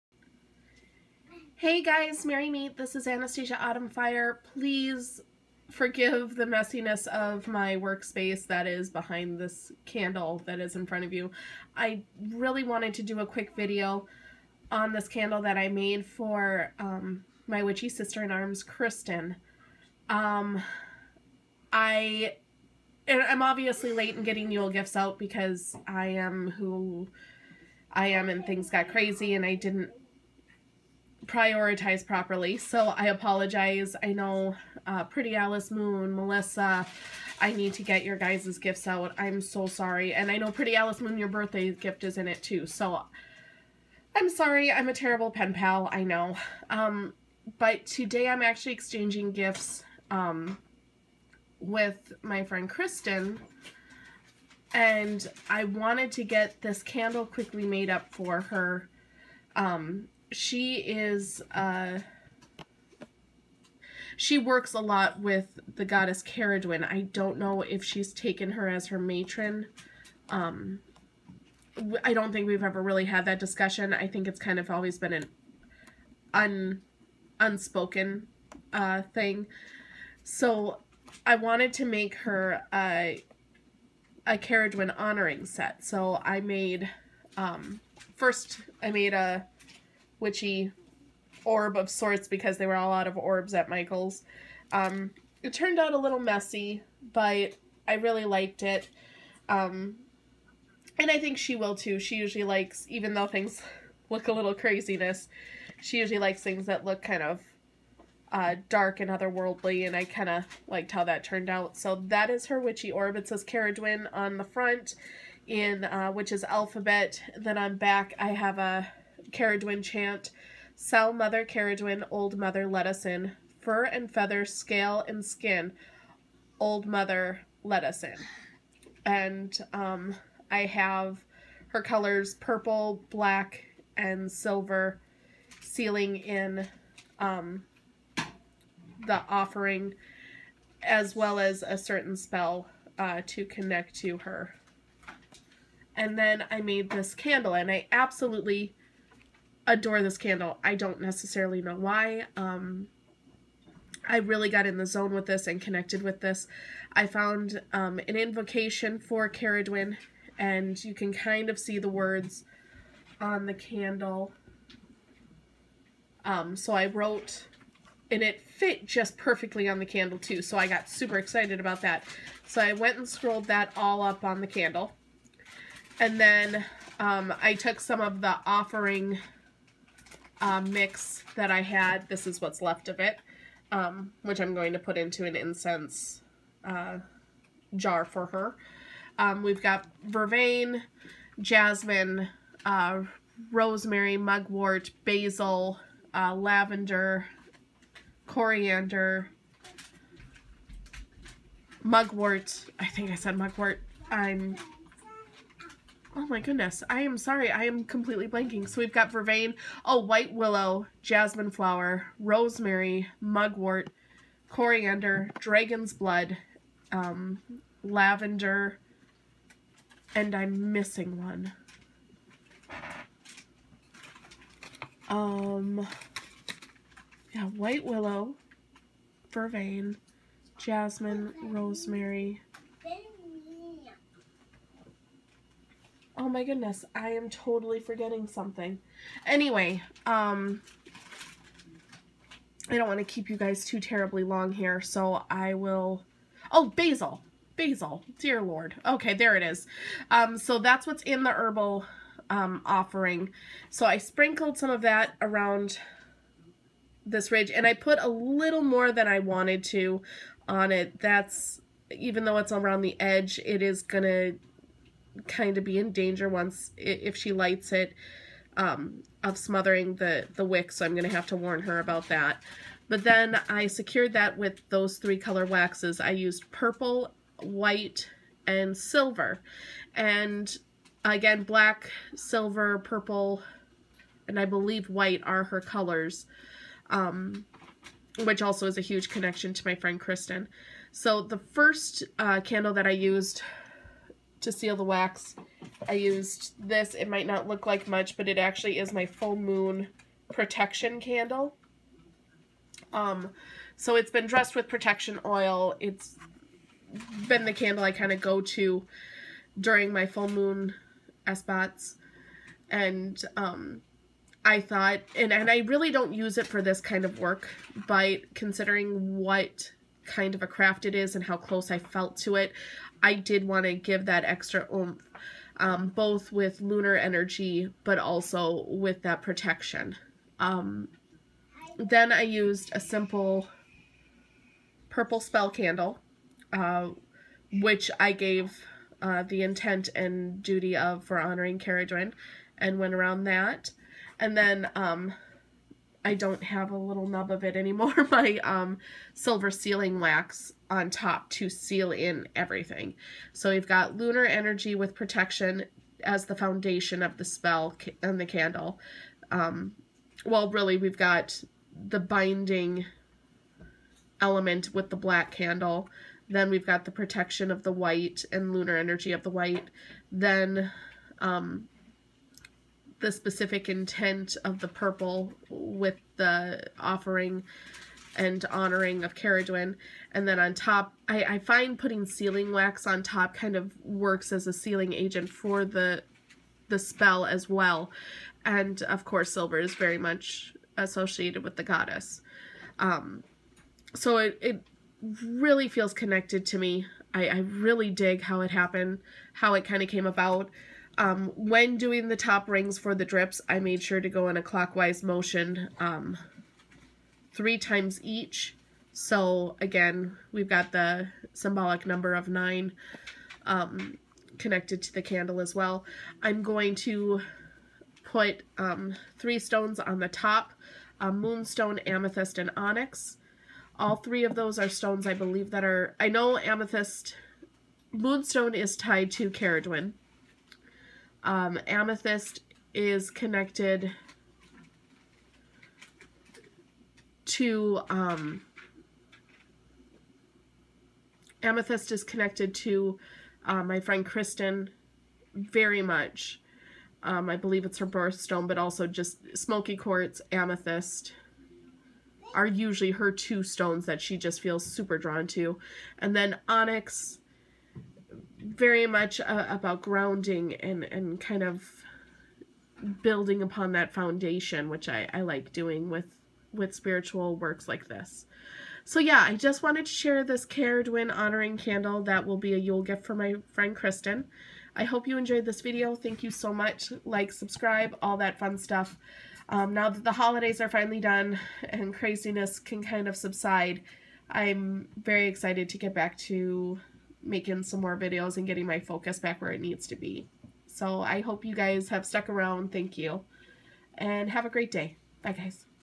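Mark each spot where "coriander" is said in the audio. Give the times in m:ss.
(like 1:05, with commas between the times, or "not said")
3:18, 3:34.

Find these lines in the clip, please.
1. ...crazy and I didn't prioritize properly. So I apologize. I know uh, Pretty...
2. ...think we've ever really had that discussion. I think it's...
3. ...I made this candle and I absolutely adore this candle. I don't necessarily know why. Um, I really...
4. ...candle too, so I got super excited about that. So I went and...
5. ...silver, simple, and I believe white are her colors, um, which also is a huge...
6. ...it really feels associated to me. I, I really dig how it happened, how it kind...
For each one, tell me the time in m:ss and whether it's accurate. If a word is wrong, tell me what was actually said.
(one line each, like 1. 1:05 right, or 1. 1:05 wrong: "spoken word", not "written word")
1. 0:28 right
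2. 1:12 right
3. 2:26 right
4. 2:49 right
5. 4:42 wrong: "purple", not "simple"
6. 6:34 wrong: "connected", not "associated".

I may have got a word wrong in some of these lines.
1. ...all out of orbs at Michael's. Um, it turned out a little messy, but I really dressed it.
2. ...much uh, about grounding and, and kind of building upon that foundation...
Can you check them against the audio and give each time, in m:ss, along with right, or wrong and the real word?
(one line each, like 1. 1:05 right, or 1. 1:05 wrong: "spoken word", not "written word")
1. 1:32 wrong: "liked", not "dressed"
2. 7:38 right.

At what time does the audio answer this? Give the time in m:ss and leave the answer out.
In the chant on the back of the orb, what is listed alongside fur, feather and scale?
2:05.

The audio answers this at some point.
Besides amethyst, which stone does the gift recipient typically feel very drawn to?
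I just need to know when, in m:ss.
7:29.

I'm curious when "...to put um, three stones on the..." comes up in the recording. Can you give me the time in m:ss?
6:56.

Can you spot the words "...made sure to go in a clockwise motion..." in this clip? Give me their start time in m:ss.
6:43.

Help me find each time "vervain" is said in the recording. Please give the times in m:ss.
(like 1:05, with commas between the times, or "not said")
3:10, 3:29, 3:49.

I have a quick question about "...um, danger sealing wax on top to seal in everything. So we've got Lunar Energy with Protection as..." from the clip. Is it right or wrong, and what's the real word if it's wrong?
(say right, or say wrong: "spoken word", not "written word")
wrong: "silver", not "danger".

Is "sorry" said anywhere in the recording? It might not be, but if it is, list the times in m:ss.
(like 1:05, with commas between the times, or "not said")
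0:39, 0:44, 3:27.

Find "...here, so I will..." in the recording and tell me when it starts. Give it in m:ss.
4:04.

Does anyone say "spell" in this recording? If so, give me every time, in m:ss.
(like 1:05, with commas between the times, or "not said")
2:22, 5:35, 5:57, 6:26.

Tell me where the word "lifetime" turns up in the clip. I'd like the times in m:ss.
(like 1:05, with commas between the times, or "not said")
not said.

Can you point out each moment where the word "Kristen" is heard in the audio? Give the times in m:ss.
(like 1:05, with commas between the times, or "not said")
0:18, 0:52, 4:49, 7:24, 7:53.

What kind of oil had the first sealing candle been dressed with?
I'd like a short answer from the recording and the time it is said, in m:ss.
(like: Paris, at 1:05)
protection oil, at 5:04.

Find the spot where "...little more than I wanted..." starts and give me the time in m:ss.
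4:18.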